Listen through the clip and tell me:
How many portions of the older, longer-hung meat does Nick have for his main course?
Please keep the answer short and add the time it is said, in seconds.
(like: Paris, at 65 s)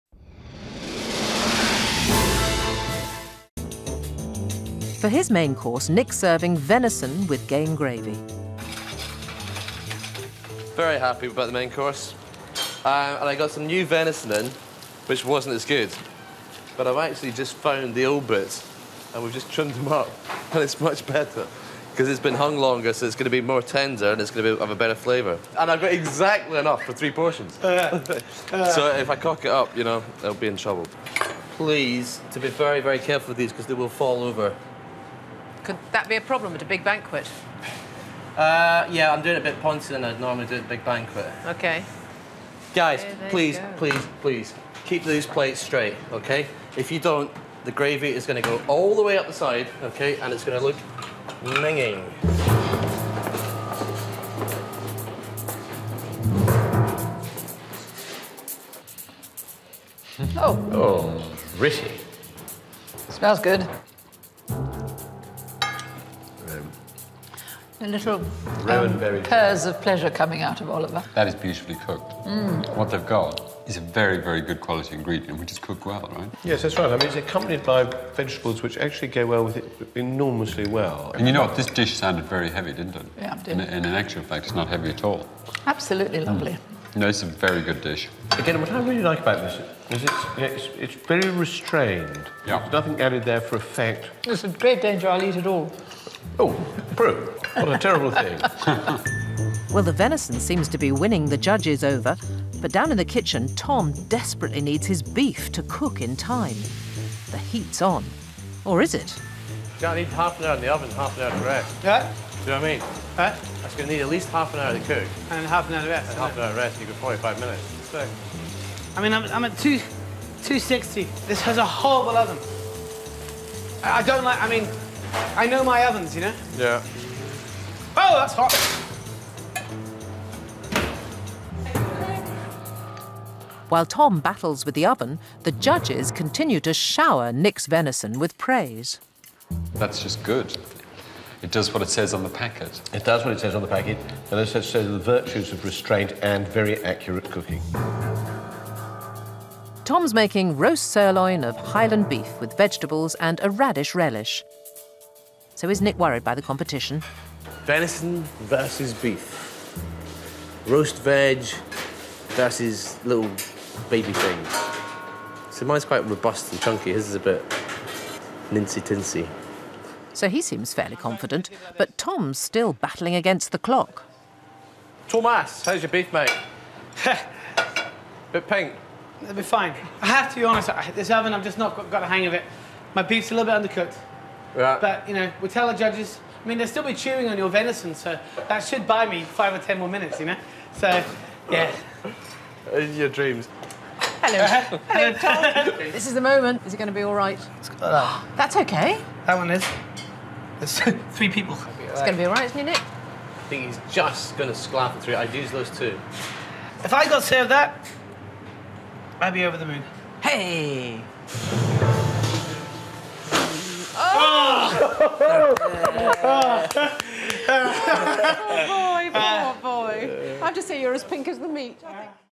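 3, at 26 s.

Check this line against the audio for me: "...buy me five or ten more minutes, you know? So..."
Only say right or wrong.
right.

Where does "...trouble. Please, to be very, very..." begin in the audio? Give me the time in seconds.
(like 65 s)
30 s.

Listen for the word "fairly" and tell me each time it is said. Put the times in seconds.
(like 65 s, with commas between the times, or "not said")
170 s.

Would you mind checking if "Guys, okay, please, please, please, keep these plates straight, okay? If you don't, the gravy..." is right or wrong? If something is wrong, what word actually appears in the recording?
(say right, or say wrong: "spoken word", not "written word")
right.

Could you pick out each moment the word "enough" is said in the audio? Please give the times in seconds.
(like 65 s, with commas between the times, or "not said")
26 s.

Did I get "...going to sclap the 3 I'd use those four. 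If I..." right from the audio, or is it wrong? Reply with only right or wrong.
wrong.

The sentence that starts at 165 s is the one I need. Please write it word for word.
So mine's quite robust and chunky.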